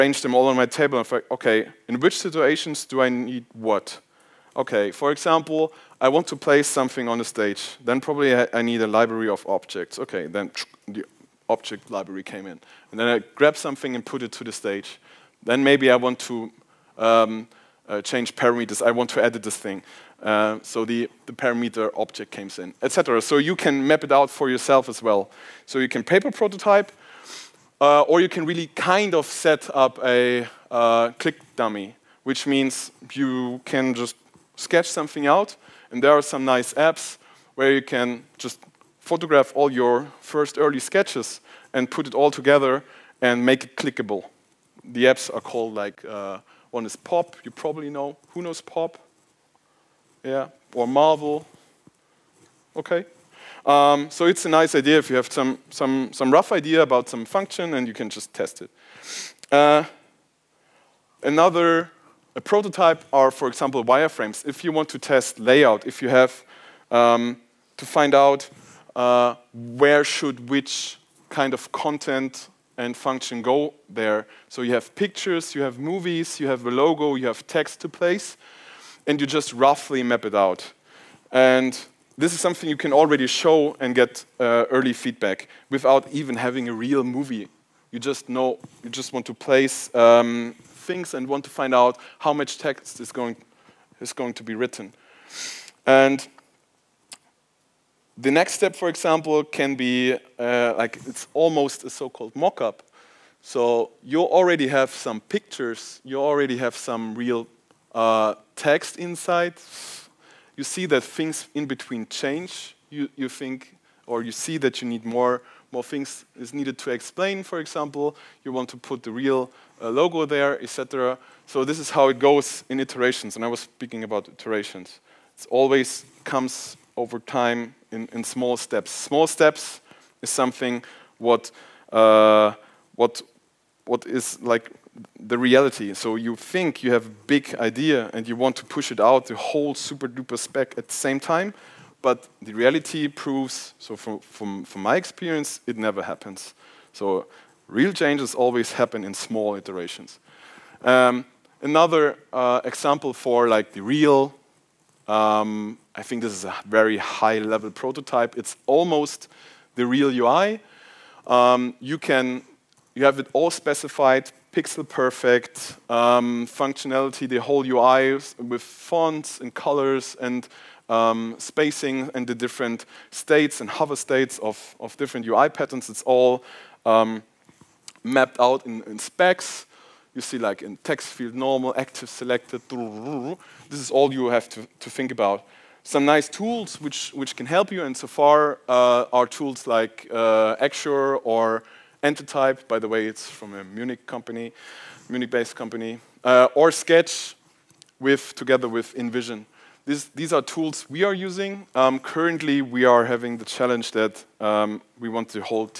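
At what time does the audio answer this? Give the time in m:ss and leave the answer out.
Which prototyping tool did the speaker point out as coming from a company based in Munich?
3:12.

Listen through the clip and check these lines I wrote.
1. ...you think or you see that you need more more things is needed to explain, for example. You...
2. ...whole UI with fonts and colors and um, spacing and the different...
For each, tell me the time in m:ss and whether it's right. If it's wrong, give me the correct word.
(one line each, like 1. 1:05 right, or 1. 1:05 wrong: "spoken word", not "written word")
1. 1:53 right
2. 2:47 right.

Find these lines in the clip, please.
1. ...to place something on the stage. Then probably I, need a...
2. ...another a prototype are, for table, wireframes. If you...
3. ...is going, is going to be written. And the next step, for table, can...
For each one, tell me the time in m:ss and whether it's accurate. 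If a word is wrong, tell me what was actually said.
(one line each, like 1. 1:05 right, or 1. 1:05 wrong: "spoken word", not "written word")
1. 0:06 right
2. 1:01 wrong: "example", not "table"
3. 1:33 wrong: "example", not "table".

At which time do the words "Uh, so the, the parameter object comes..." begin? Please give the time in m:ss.
0:20.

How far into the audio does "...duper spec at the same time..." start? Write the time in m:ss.
2:20.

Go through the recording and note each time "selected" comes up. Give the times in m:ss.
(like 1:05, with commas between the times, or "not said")
3:02.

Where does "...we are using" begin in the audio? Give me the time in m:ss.
3:20.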